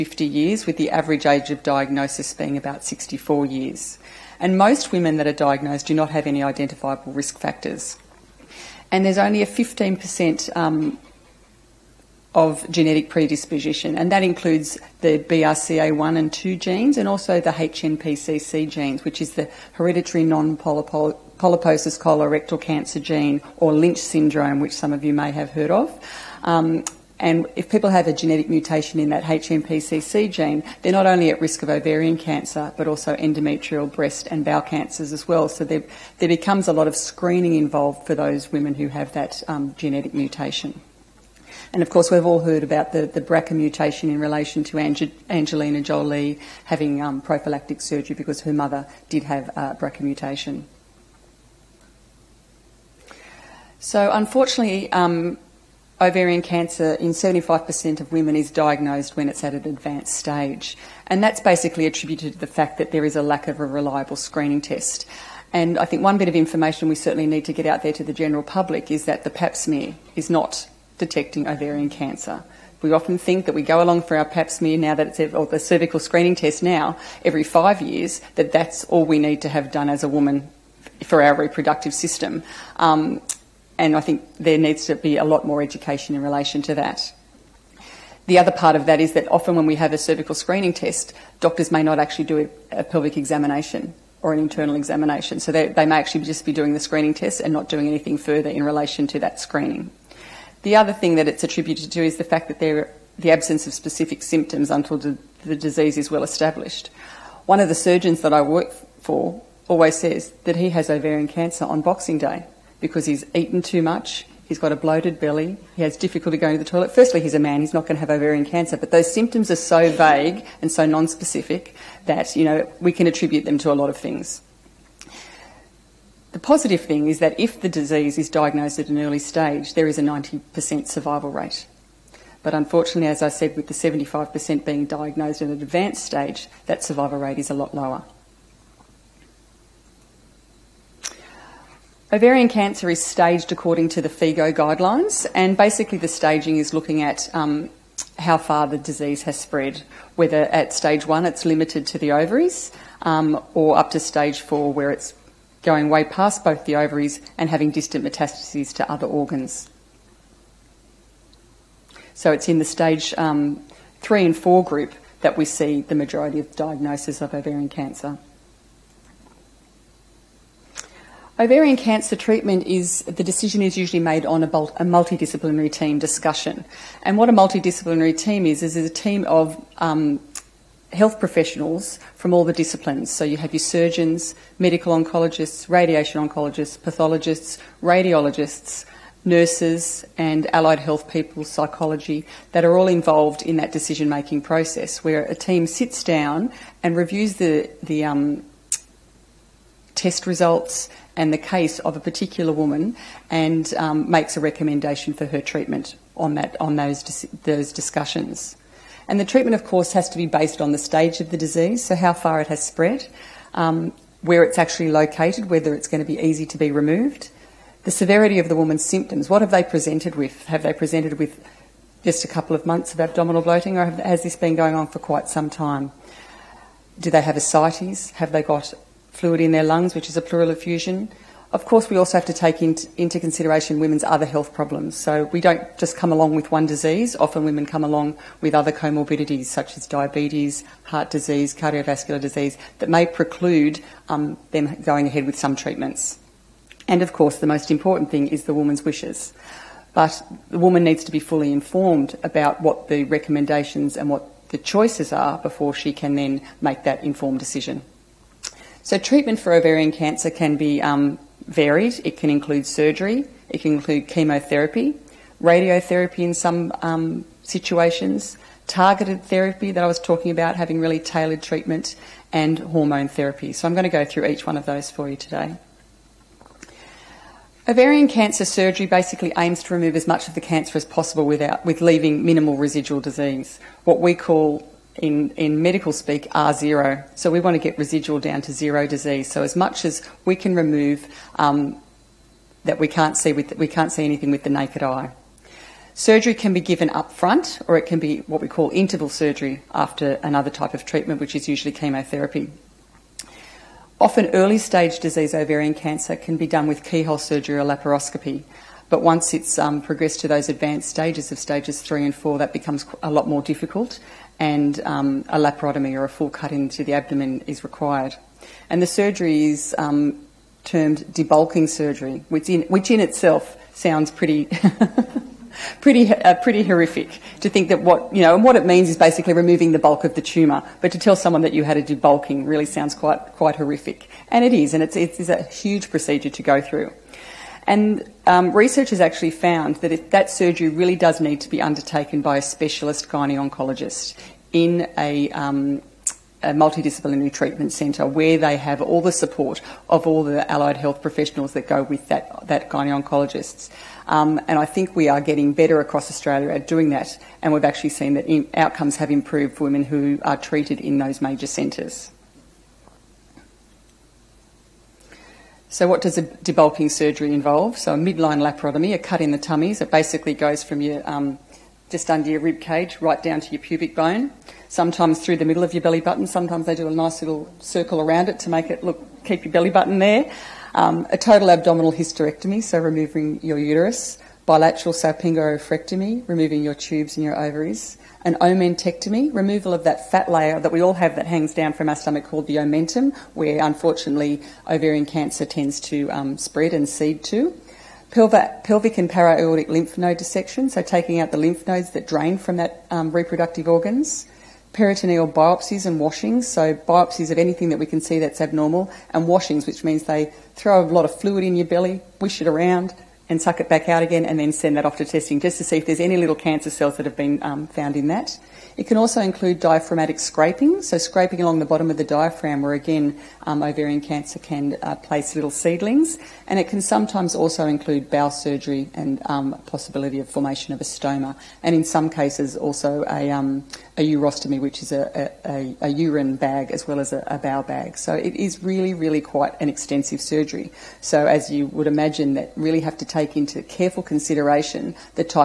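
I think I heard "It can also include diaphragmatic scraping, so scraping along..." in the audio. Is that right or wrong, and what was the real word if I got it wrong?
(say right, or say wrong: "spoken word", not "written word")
right.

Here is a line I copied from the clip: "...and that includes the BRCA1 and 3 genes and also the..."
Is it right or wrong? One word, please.
wrong.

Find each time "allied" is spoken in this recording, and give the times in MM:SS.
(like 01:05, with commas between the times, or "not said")
03:10, 05:50.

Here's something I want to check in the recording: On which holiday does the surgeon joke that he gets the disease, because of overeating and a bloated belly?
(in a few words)
Boxing Day.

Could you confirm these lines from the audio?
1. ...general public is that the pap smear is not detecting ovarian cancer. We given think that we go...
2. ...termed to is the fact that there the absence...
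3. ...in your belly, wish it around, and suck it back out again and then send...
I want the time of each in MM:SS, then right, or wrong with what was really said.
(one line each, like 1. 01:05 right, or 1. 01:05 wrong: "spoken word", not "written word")
1. 01:08 wrong: "often", not "given"
2. 01:41 wrong: "attributed", not "termed"
3. 06:51 right.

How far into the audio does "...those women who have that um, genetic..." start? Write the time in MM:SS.
00:38.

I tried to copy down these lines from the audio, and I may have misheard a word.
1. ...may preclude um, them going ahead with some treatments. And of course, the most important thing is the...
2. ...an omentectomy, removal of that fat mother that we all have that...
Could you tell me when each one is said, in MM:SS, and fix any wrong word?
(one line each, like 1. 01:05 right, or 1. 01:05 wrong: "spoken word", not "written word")
1. 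04:02 right
2. 06:28 wrong: "layer", not "mother".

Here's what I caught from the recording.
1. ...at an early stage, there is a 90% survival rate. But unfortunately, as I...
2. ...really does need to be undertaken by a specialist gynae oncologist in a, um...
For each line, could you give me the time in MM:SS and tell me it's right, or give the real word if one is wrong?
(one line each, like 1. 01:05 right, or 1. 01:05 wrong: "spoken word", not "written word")
1. 02:08 right
2. 05:40 right.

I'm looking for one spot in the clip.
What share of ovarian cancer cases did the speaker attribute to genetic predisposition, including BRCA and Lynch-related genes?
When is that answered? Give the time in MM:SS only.
00:09.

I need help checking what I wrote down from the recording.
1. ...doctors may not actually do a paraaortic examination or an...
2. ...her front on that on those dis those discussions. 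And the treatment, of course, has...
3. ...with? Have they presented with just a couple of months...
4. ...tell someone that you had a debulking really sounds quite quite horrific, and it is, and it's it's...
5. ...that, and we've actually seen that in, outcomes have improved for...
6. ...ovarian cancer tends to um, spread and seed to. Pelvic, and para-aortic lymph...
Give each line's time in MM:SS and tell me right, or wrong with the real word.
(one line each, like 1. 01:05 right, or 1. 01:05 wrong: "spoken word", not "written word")
1. 01:31 wrong: "pelvic", not "paraaortic"
2. 03:25 wrong: "treatment", not "front"
3. 03:40 right
4. 05:30 right
5. 05:56 right
6. 06:34 right.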